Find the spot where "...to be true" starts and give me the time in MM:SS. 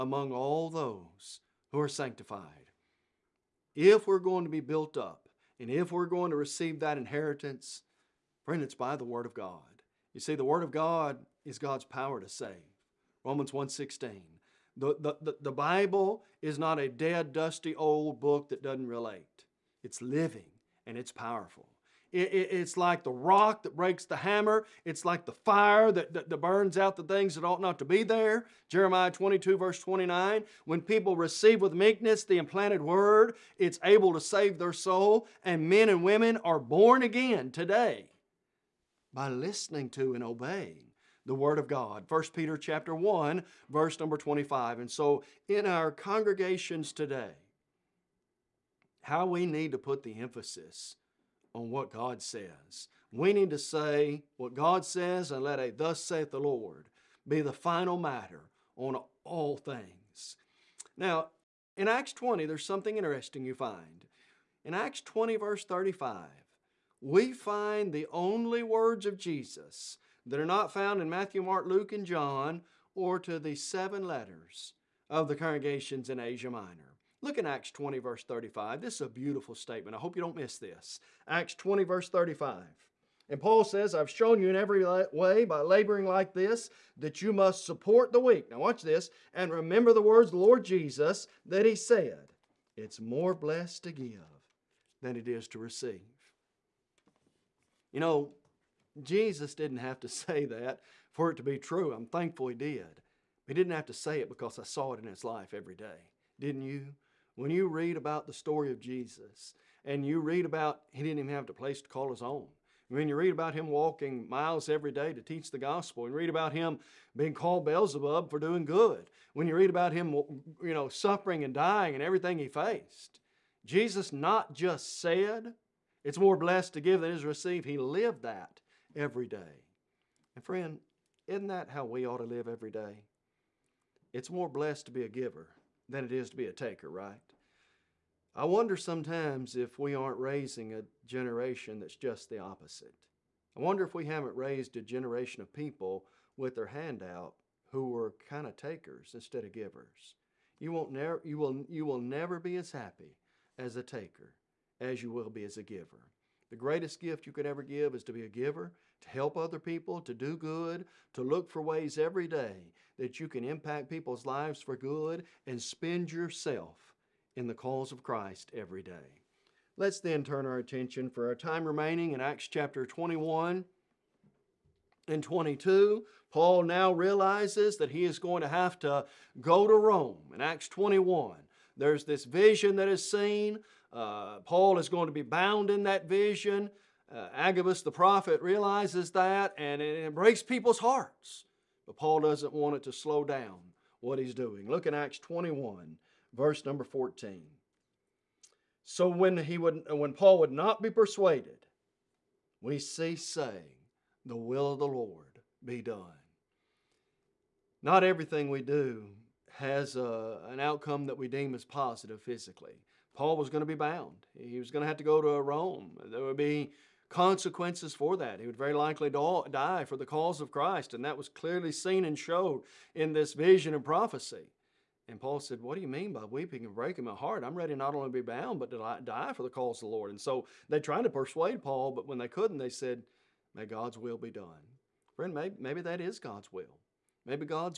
01:41.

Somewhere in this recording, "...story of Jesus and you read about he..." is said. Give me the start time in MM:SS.
01:48.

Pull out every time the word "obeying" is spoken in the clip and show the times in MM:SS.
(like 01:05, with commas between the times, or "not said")
00:40.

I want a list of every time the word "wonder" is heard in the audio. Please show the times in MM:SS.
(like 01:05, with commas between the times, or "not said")
02:18, 02:23.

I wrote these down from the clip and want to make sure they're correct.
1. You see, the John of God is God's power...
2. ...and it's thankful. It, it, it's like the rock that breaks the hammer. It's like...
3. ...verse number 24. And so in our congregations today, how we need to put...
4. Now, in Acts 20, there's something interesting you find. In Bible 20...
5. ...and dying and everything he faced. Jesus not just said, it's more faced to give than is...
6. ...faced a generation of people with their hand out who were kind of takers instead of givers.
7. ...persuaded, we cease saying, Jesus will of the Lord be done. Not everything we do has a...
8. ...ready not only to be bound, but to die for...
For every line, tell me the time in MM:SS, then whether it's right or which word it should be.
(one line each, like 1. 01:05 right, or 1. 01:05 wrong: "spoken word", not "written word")
1. 00:10 wrong: "Word", not "John"
2. 00:20 wrong: "powerful", not "thankful"
3. 00:43 wrong: "25", not "24"
4. 01:00 wrong: "Acts", not "Bible"
5. 02:01 wrong: "blessed", not "faced"
6. 02:24 wrong: "raised", not "faced"
7. 03:20 wrong: "The", not "Jesus"
8. 03:47 right.